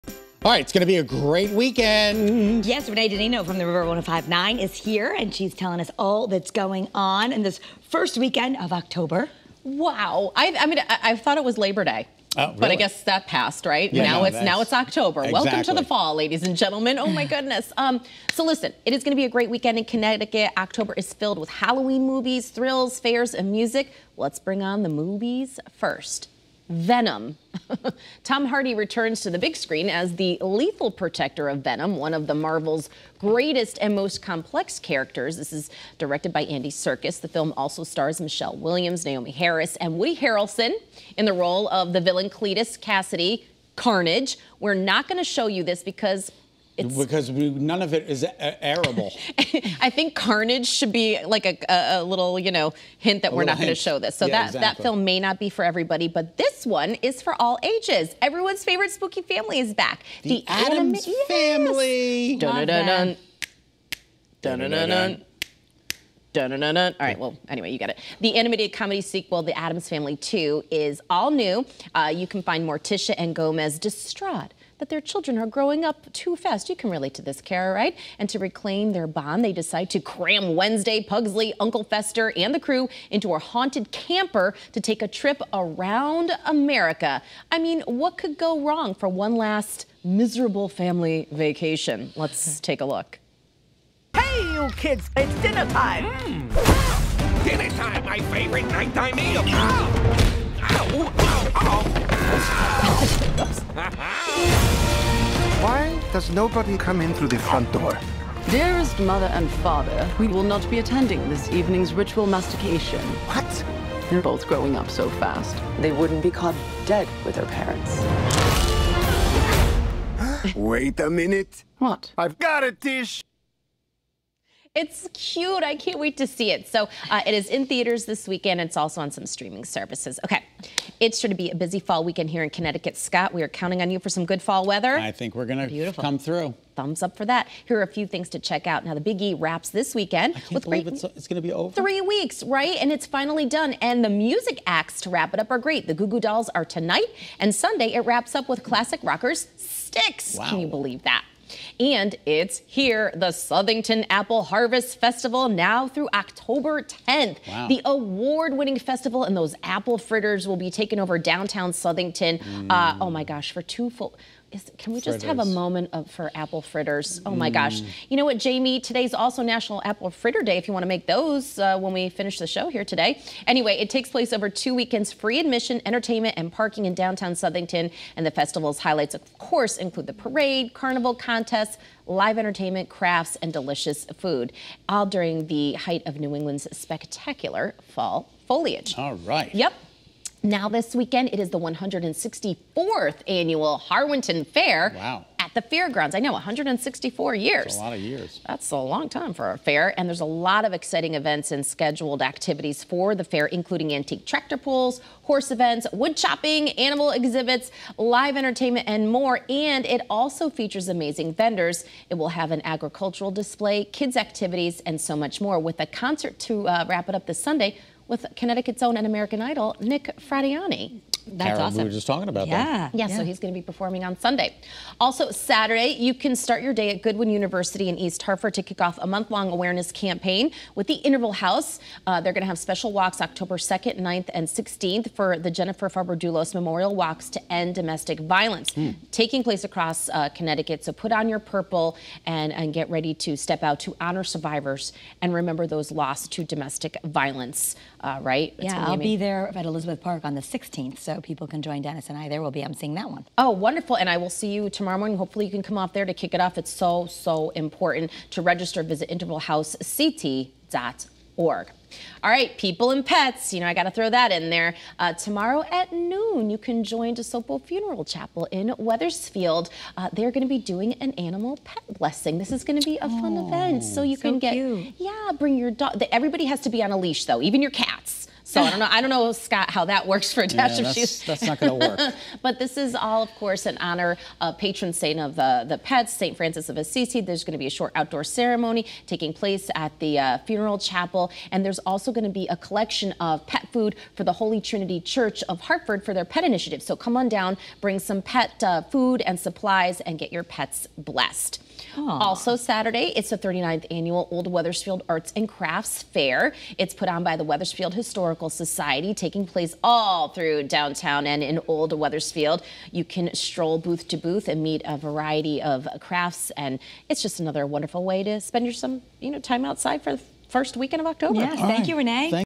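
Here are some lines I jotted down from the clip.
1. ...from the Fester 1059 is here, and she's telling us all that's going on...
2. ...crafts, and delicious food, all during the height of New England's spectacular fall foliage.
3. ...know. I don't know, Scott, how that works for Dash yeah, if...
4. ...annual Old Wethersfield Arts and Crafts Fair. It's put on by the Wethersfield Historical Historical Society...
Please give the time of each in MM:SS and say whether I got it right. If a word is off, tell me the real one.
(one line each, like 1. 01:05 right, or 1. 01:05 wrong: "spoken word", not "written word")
1. 00:03 wrong: "River", not "Fester"
2. 03:02 right
3. 04:38 right
4. 05:03 right.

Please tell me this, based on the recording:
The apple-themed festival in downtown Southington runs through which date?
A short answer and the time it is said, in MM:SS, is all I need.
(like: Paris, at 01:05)
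October 10th, at 02:36.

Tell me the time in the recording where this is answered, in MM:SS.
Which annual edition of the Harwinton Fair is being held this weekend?
03:11.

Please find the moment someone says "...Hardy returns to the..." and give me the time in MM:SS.
00:28.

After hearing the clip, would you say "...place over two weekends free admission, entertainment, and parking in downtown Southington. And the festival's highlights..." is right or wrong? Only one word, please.
right.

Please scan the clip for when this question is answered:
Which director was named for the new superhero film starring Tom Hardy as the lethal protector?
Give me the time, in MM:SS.
00:36.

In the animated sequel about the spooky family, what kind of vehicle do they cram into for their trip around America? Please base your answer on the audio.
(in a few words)
haunted camper.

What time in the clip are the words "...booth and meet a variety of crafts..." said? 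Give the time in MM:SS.
05:14.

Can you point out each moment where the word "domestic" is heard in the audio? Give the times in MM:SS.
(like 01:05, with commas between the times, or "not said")
03:57, 04:06.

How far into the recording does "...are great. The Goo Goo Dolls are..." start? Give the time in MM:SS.
02:25.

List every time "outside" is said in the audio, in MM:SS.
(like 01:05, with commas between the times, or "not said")
05:19.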